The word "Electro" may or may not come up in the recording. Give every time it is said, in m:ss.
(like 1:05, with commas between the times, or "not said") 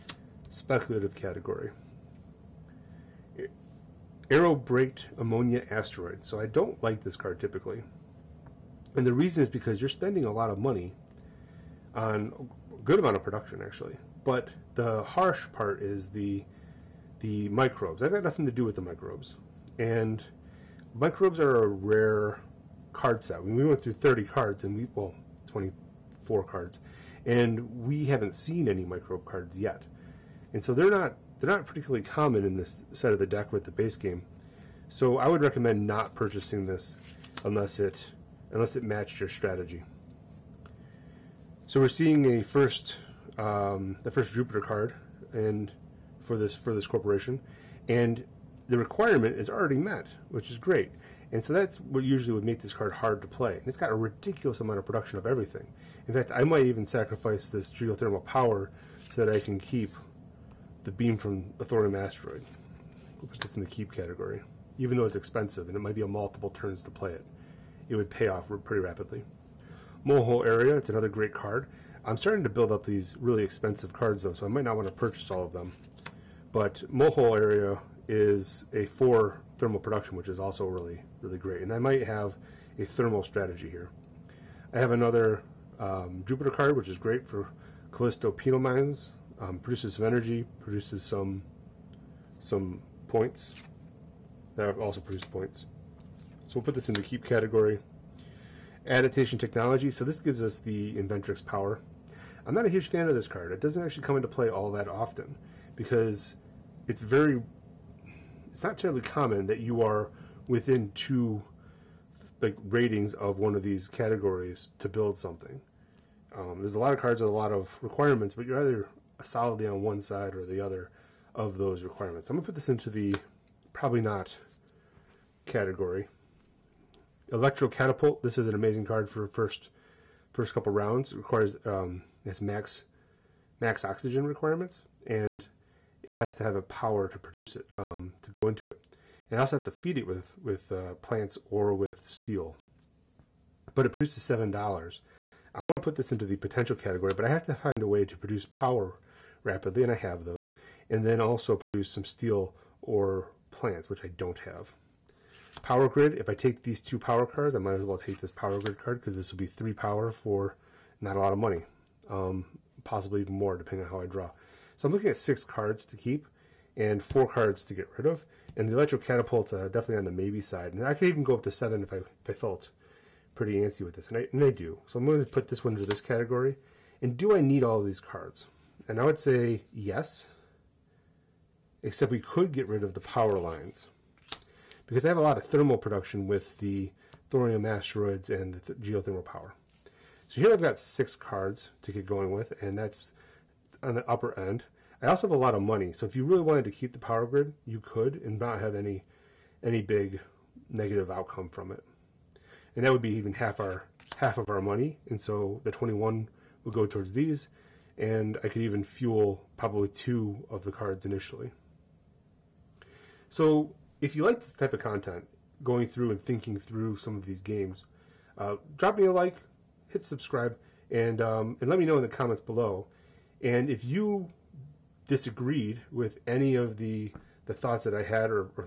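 2:07, 2:48.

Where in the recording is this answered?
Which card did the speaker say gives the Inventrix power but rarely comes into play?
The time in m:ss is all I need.
1:38.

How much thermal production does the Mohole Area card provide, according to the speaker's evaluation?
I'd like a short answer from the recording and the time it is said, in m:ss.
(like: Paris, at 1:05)
4, at 1:18.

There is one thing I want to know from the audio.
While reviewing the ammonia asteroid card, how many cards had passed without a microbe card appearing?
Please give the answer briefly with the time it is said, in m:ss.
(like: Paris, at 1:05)
24, at 0:25.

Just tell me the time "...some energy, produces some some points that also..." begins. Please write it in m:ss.
1:29.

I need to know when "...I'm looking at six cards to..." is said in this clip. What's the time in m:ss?
2:44.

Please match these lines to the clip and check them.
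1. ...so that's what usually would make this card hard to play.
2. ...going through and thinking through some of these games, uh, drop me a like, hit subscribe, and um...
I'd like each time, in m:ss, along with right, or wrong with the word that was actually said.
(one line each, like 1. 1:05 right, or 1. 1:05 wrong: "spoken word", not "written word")
1. 0:51 right
2. 3:35 right.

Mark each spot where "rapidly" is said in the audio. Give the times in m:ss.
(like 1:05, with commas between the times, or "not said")
1:08, 2:29.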